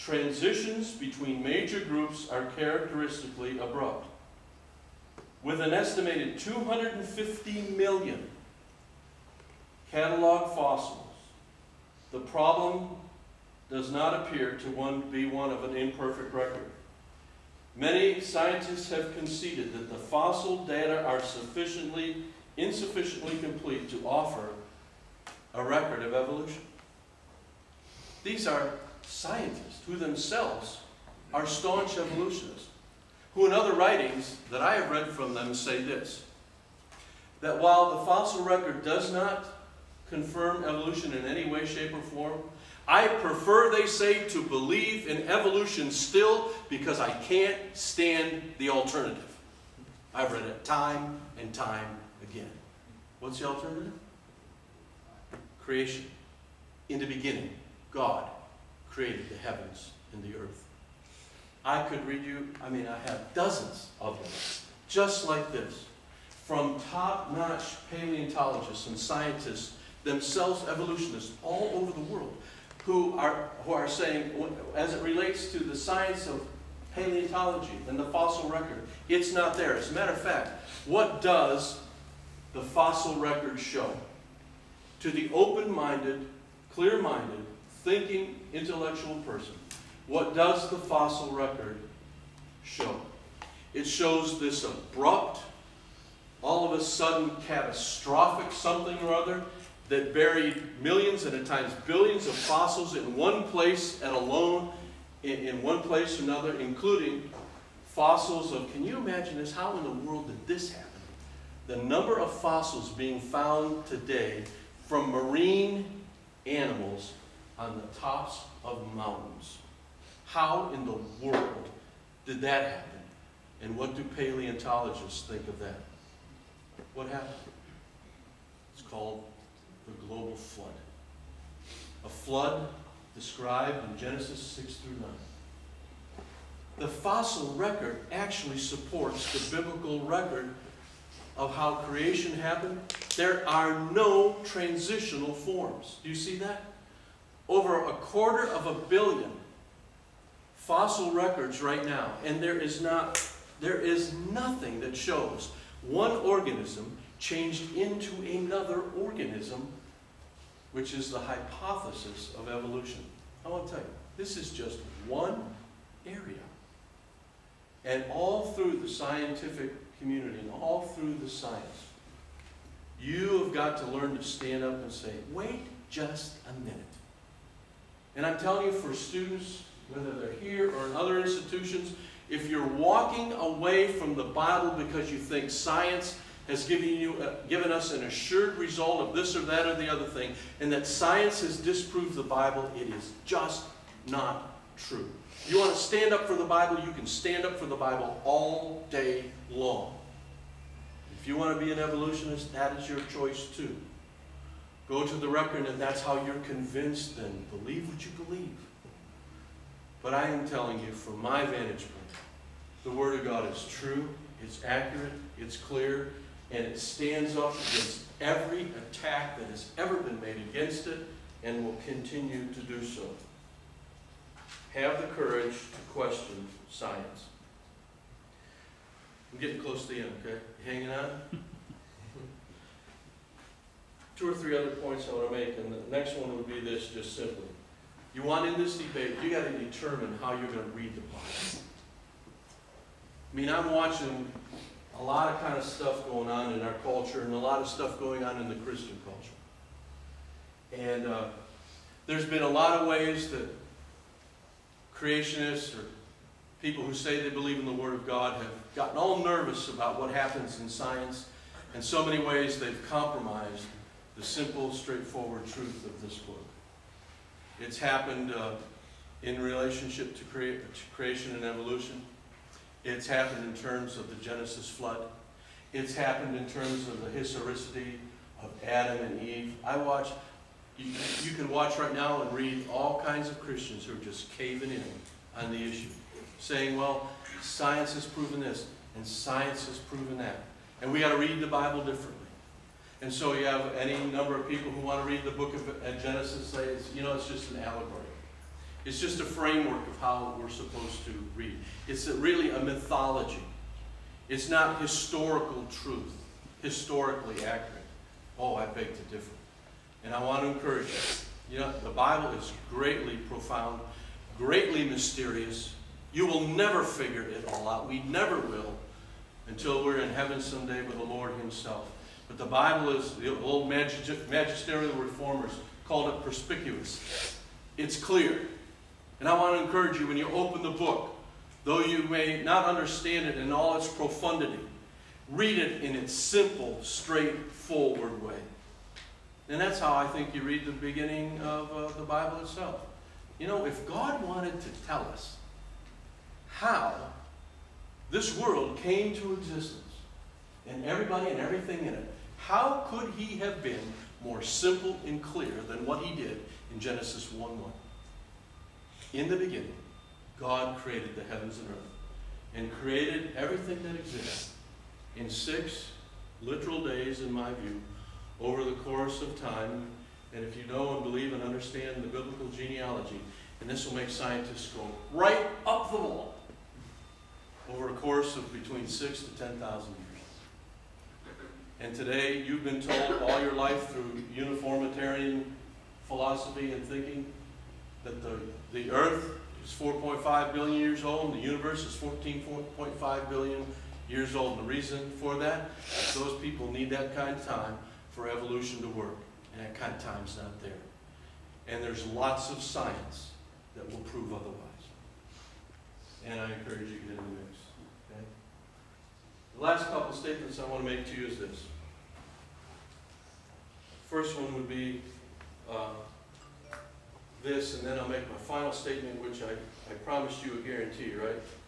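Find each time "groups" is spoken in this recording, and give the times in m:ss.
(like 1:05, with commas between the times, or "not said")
0:01.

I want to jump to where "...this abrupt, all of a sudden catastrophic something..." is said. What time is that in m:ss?
1:34.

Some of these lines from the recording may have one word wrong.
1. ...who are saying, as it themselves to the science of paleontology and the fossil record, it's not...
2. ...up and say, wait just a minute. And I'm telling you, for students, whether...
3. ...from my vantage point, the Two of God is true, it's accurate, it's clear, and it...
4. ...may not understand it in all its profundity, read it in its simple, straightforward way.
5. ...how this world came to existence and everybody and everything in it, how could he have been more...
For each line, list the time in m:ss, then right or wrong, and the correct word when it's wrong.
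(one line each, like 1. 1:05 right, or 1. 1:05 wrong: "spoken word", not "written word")
1. 1:13 wrong: "relates", not "themselves"
2. 2:54 right
3. 3:30 wrong: "Word", not "Two"
4. 5:32 right
5. 5:46 right.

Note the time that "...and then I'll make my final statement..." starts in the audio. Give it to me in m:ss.
6:57.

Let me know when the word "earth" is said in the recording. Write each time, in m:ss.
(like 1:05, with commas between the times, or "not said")
1:00, 6:01, 6:28.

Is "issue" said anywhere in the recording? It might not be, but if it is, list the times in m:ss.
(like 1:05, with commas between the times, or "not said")
4:45.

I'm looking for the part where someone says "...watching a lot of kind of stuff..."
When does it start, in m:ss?
4:03.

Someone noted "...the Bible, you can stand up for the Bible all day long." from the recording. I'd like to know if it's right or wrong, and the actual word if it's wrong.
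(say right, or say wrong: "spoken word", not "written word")
right.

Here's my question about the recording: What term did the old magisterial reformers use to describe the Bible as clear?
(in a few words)
Perspicuous.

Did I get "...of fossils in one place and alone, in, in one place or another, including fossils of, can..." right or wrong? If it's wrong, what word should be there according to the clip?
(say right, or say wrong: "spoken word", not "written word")
right.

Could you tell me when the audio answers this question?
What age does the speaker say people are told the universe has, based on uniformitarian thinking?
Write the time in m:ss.
6:31.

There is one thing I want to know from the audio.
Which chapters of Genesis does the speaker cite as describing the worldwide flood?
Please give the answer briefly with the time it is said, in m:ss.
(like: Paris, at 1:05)
6 through 9, at 2:14.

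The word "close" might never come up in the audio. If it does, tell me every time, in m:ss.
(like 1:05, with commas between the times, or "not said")
3:49.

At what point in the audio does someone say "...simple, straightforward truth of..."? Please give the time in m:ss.
4:24.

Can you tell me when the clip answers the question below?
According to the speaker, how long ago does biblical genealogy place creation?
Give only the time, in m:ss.
6:18.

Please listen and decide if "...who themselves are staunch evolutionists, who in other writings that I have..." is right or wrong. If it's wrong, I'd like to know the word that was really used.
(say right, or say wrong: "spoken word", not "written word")
right.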